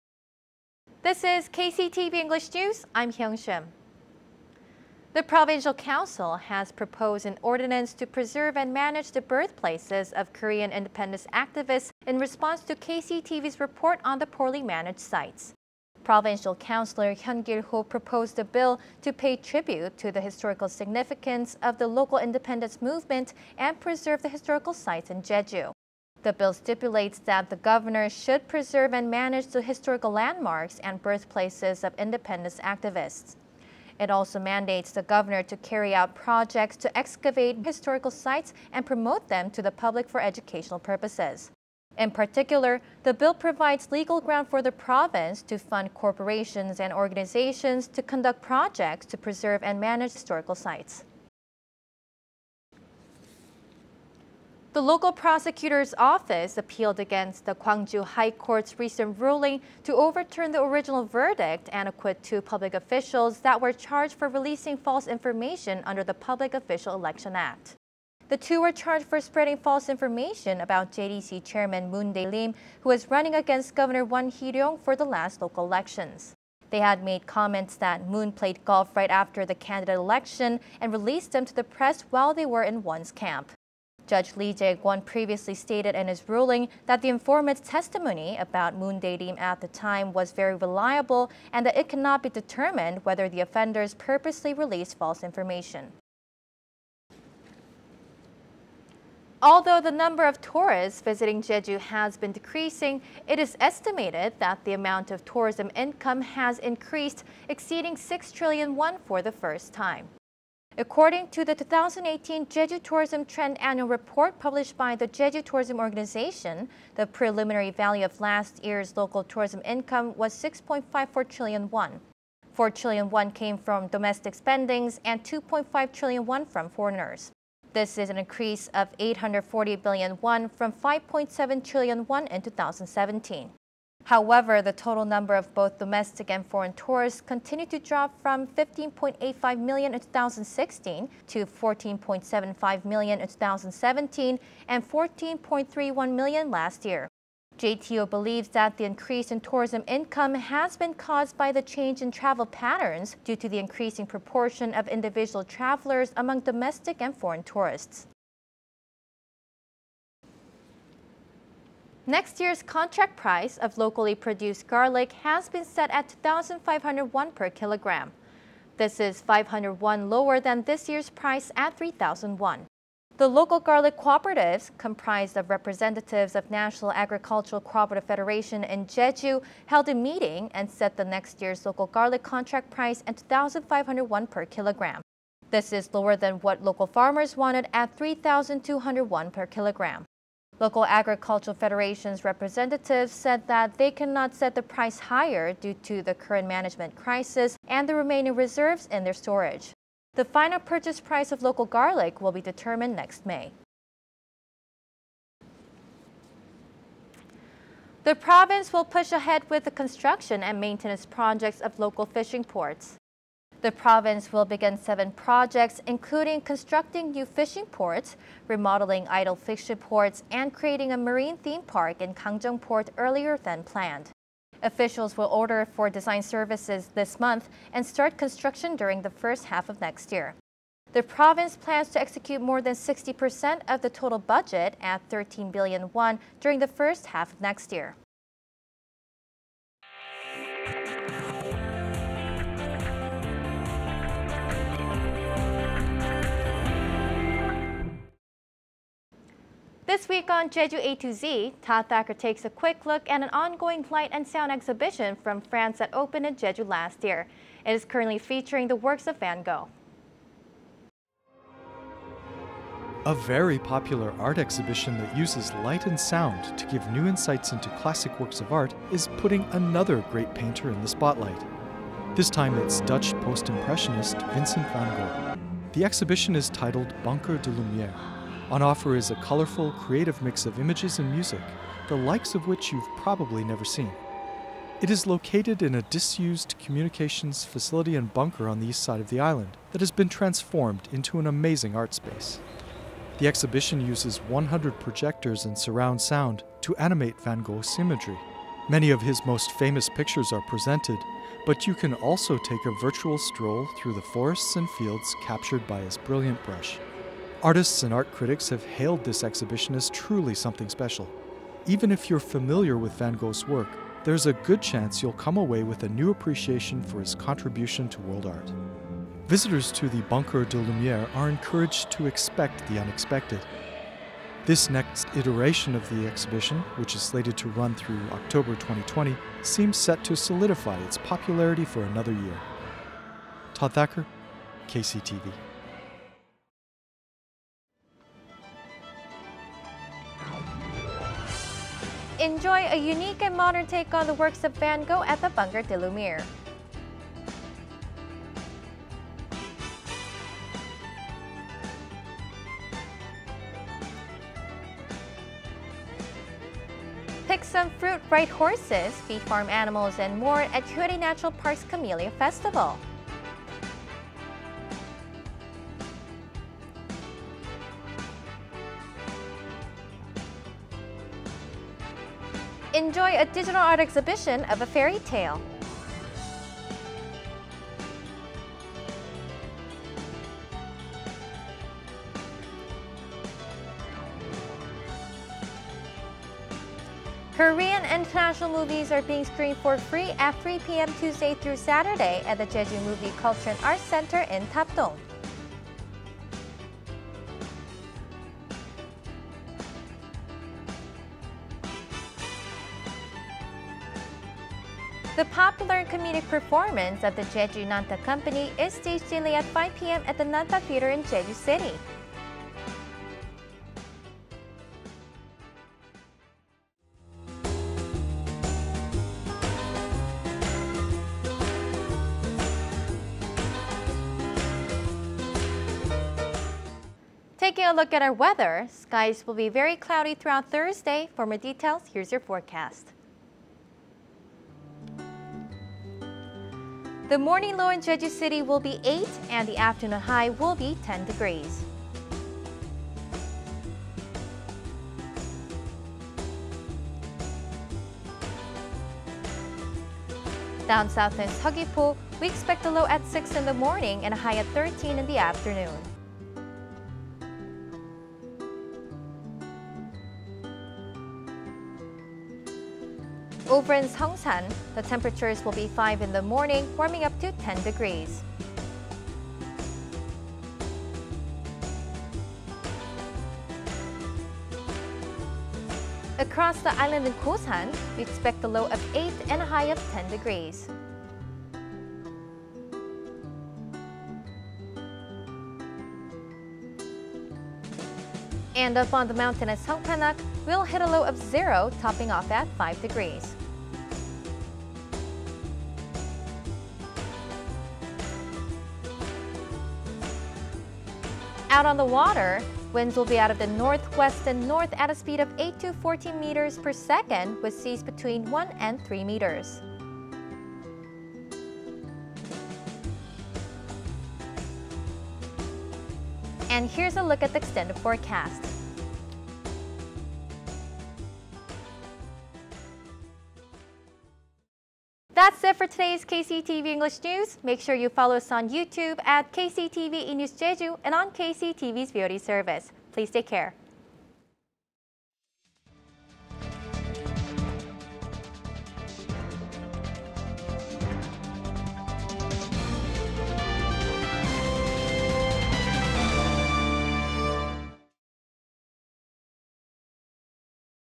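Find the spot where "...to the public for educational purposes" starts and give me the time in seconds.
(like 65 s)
39 s.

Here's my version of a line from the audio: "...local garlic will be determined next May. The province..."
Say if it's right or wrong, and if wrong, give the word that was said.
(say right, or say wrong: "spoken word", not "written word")
right.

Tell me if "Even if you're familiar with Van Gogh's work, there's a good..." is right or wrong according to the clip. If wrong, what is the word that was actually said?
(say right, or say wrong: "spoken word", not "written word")
right.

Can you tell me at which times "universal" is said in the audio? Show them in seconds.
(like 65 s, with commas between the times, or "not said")
not said.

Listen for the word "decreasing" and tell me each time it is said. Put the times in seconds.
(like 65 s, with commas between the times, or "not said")
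102 s.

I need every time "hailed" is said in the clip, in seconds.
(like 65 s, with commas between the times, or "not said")
308 s.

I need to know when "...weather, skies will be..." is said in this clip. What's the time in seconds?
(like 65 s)
428 s.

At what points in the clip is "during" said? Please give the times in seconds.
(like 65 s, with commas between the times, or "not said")
228 s, 236 s.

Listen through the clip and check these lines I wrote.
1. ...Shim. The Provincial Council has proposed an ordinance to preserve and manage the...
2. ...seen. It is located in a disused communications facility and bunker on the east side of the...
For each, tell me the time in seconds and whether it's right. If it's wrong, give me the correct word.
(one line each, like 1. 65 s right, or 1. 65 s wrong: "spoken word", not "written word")
1. 3 s right
2. 283 s right.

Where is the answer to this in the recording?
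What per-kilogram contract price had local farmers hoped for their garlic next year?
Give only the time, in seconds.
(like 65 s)
187 s.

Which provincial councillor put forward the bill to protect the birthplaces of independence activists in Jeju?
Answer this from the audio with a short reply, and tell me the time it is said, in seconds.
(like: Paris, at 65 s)
Hyun Gil-ho, at 17 s.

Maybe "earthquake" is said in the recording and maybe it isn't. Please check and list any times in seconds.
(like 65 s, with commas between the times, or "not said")
not said.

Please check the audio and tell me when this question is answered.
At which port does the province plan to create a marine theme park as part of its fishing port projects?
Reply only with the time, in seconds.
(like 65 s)
222 s.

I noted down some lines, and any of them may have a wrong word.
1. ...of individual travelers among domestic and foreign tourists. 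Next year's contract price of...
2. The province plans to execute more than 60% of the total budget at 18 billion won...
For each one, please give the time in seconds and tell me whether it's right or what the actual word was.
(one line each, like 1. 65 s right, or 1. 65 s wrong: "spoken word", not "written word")
1. 154 s right
2. 230 s wrong: "13", not "18".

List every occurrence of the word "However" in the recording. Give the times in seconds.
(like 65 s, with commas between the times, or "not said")
134 s.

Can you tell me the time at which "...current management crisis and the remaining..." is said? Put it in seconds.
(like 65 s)
196 s.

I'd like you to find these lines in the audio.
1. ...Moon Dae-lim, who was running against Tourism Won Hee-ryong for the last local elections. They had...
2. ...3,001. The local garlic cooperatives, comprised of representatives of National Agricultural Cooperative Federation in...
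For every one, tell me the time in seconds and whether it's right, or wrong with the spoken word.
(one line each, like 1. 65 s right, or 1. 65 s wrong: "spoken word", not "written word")
1. 71 s wrong: "Governor", not "Tourism"
2. 171 s right.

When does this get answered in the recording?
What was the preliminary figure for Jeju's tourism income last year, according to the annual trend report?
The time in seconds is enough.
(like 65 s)
120 s.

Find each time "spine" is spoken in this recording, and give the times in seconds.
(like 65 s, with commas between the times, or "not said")
not said.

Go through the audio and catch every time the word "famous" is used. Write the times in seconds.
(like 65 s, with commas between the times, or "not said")
299 s.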